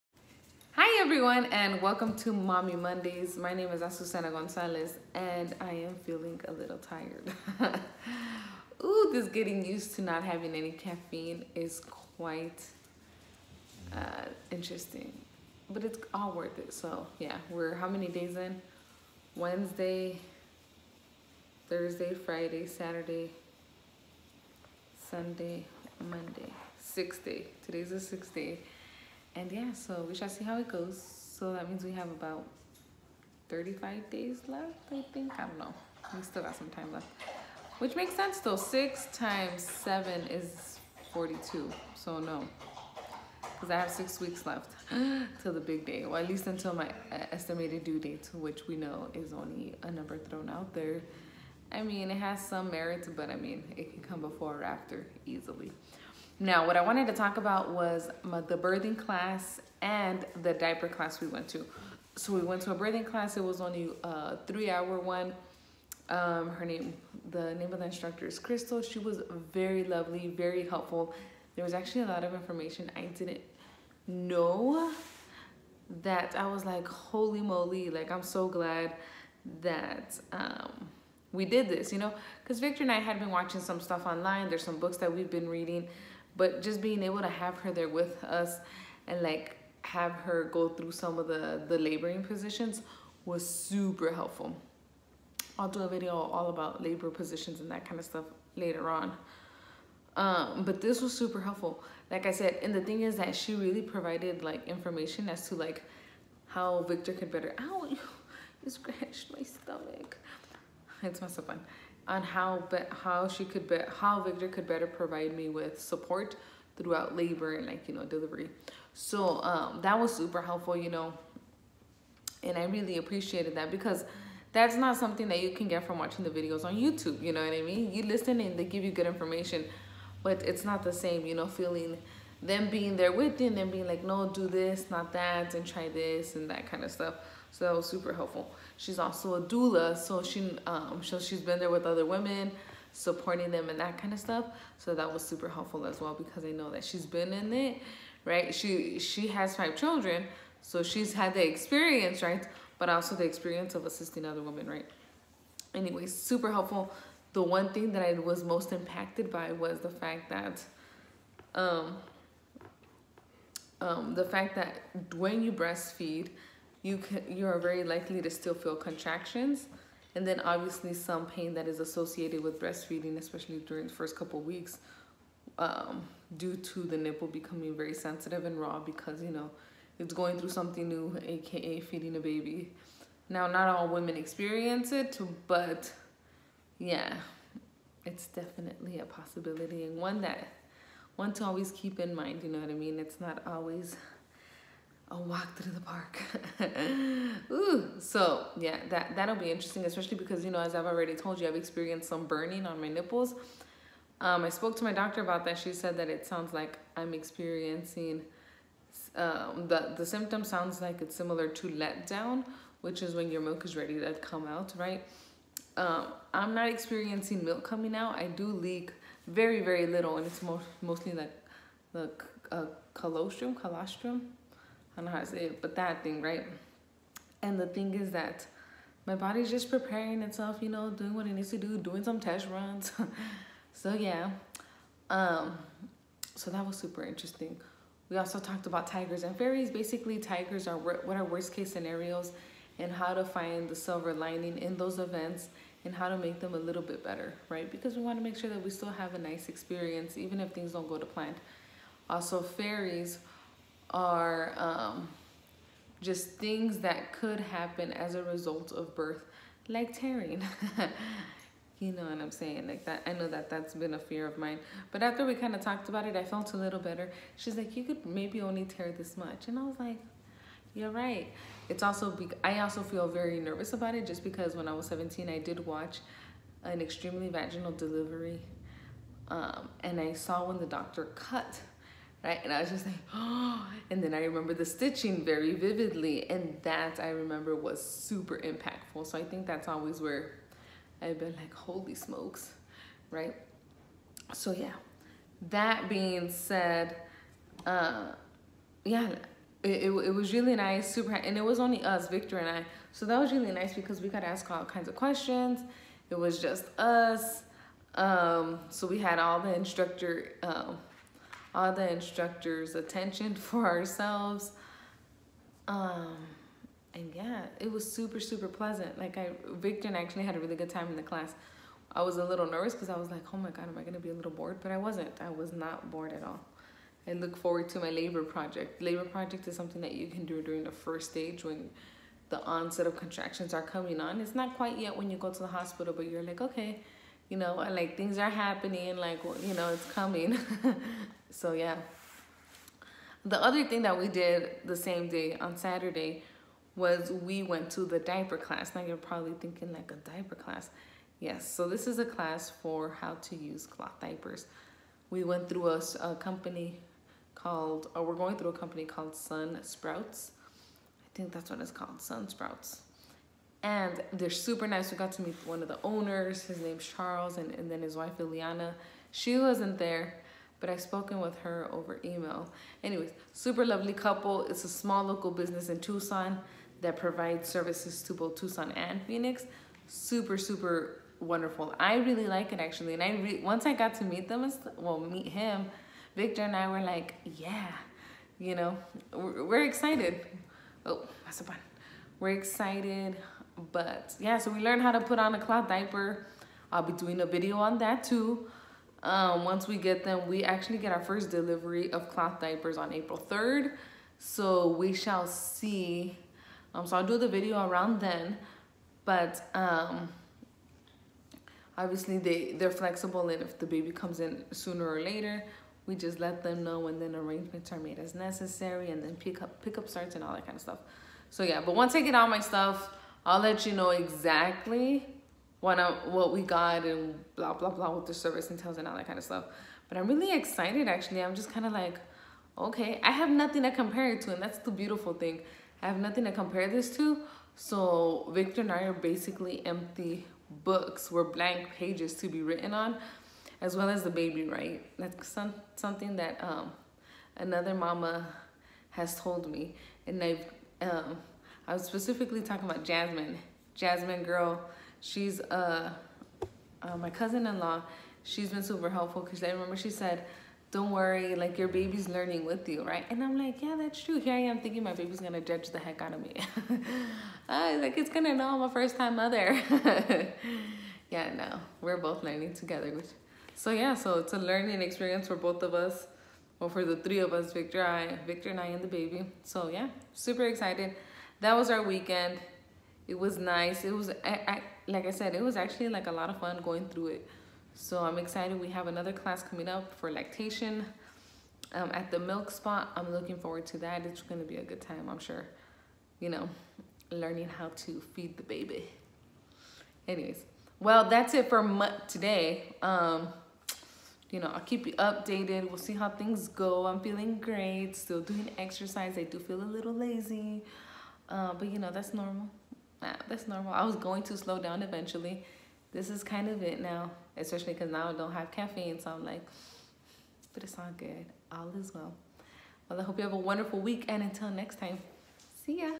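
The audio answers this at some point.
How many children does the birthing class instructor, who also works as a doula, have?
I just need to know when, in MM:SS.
02:29.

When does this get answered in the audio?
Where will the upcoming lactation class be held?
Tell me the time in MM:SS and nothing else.
08:12.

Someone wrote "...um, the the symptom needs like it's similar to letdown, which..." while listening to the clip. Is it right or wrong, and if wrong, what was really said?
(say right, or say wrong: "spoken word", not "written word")
wrong: "sounds", not "needs".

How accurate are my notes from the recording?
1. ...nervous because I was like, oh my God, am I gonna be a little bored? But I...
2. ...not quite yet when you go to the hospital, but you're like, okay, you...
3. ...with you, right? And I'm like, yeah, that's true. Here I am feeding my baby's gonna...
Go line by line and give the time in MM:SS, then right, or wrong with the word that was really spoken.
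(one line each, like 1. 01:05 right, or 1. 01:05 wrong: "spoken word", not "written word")
1. 05:22 right
2. 05:34 right
3. 07:42 wrong: "thinking", not "feeding".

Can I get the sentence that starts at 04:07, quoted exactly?
Because we want to make sure that we still have a nice experience, even if things don't go to plan.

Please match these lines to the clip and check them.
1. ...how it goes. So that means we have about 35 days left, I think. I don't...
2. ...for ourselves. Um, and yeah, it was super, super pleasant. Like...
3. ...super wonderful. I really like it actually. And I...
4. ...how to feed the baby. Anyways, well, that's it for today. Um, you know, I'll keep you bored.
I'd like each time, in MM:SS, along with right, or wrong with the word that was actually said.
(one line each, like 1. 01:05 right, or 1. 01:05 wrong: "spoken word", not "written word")
1. 00:30 right
2. 05:13 right
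3. 06:20 right
4. 08:17 wrong: "updated", not "bored".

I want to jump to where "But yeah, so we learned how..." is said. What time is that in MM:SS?
06:33.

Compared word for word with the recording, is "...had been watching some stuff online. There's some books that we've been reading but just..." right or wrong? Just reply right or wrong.
right.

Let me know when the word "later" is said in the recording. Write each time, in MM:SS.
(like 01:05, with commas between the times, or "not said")
01:38, 06:55.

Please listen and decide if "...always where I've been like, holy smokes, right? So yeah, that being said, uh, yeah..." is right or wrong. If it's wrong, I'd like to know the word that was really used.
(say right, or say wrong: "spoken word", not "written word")
right.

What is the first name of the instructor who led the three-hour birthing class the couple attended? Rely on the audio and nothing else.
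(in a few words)
Crystal.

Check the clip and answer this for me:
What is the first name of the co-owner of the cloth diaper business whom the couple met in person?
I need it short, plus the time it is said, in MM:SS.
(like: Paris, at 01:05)
Charles, at 06:06.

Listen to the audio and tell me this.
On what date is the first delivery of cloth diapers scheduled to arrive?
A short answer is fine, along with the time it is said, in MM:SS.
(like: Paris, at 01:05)
April 3rd, at 06:42.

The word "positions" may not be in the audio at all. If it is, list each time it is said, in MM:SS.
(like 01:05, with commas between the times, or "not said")
01:32, 01:37.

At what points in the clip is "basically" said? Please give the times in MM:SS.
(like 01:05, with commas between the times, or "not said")
03:59, 07:18.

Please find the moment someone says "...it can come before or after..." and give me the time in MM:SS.
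00:53.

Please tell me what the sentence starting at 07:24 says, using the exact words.
That's some, something that um, another mama has told me.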